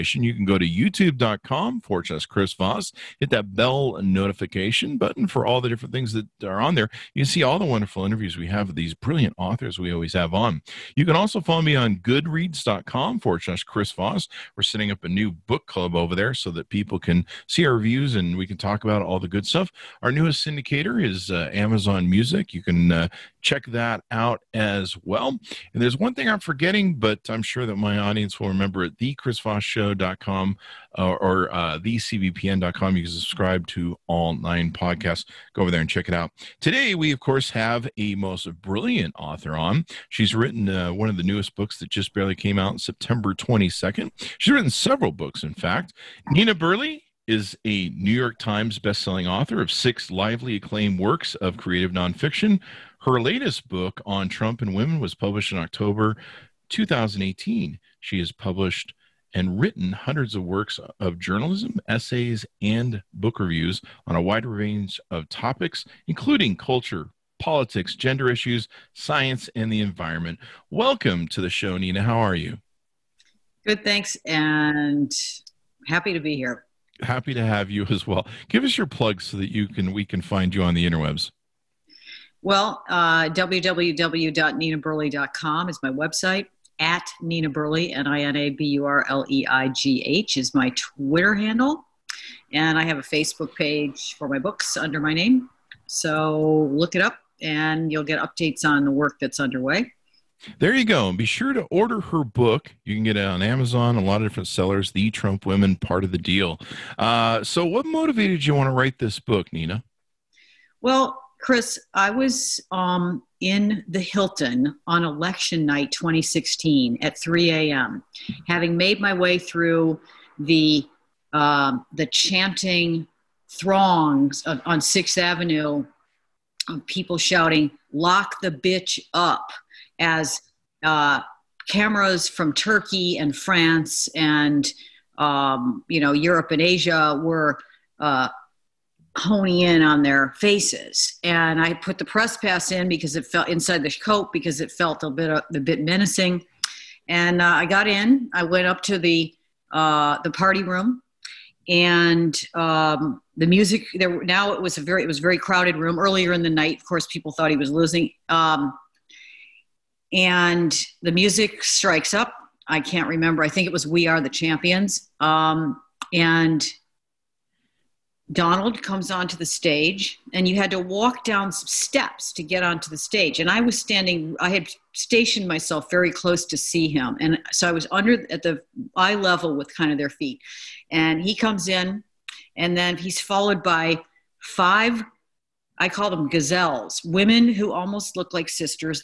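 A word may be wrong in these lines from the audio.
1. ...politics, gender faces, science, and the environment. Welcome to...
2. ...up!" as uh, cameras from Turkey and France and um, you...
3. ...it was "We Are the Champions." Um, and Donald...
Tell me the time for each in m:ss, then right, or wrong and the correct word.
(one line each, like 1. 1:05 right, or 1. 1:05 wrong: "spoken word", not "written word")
1. 1:07 wrong: "issues", not "faces"
2. 2:09 right
3. 2:43 right.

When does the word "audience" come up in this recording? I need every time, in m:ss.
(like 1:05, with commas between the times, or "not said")
0:27.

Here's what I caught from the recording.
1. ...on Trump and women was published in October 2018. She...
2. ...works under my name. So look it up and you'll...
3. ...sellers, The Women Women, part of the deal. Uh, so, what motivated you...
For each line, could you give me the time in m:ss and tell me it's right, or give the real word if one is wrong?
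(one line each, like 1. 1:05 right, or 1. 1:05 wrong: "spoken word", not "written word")
1. 0:54 right
2. 1:34 wrong: "books", not "works"
3. 1:44 wrong: "Trump", not "Women".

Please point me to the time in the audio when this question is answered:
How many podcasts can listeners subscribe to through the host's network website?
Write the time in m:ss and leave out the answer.
0:34.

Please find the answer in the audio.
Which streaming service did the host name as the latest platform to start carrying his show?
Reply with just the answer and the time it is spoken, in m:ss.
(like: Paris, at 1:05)
Amazon Music, at 0:21.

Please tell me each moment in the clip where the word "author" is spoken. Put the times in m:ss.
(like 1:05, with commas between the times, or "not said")
0:09, 0:39, 0:49.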